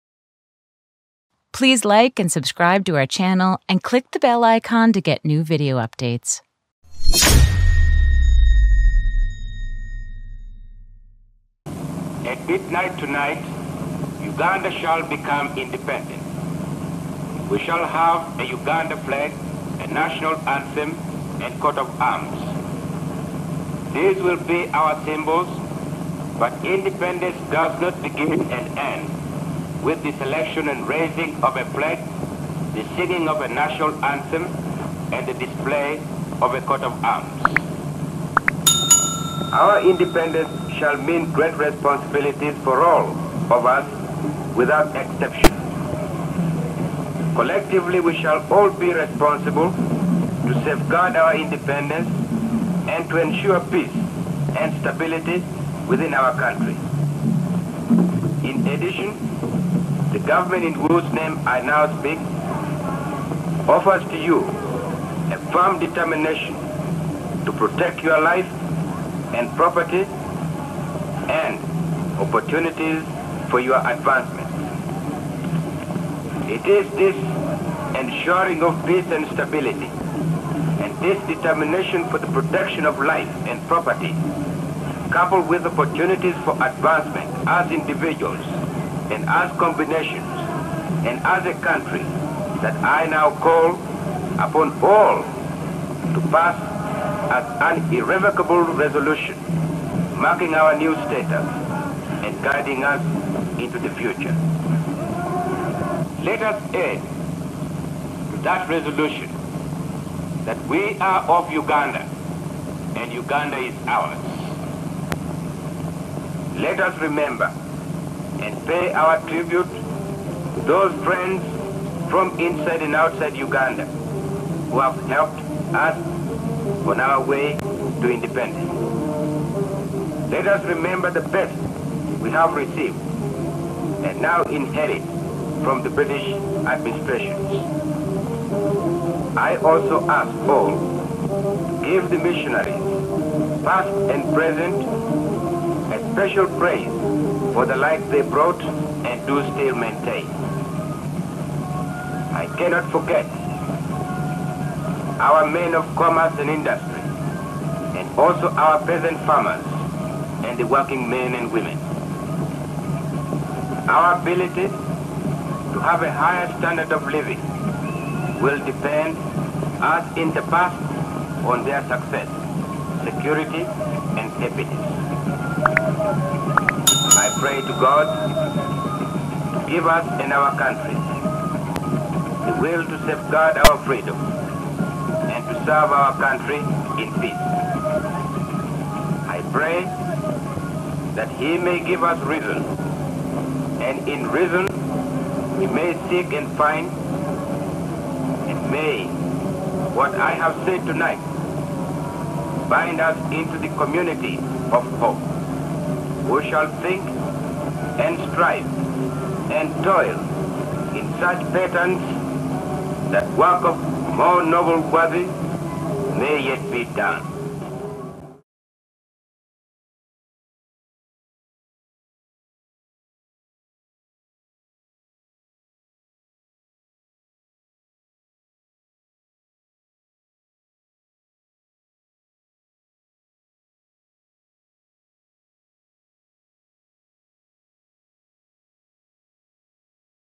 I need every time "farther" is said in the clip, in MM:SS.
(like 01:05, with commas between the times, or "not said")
not said.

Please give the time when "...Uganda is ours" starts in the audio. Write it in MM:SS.
01:53.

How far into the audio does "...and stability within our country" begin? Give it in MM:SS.
00:54.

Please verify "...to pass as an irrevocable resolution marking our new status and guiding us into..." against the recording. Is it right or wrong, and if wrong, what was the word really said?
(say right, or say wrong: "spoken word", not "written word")
right.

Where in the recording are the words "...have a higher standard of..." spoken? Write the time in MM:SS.
02:45.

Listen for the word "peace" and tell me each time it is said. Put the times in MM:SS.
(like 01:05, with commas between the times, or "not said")
00:53, 01:18, 03:07.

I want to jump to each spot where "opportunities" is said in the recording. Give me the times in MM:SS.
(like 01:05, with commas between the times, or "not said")
01:12, 01:25.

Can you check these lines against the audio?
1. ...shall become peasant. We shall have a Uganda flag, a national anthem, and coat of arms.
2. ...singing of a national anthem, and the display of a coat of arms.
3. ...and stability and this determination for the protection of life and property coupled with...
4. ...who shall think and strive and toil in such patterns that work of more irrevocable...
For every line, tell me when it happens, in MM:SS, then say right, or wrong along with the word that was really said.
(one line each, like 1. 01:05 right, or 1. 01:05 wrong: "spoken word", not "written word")
1. 00:14 wrong: "independent", not "peasant"
2. 00:32 right
3. 01:19 right
4. 03:26 wrong: "noble", not "irrevocable".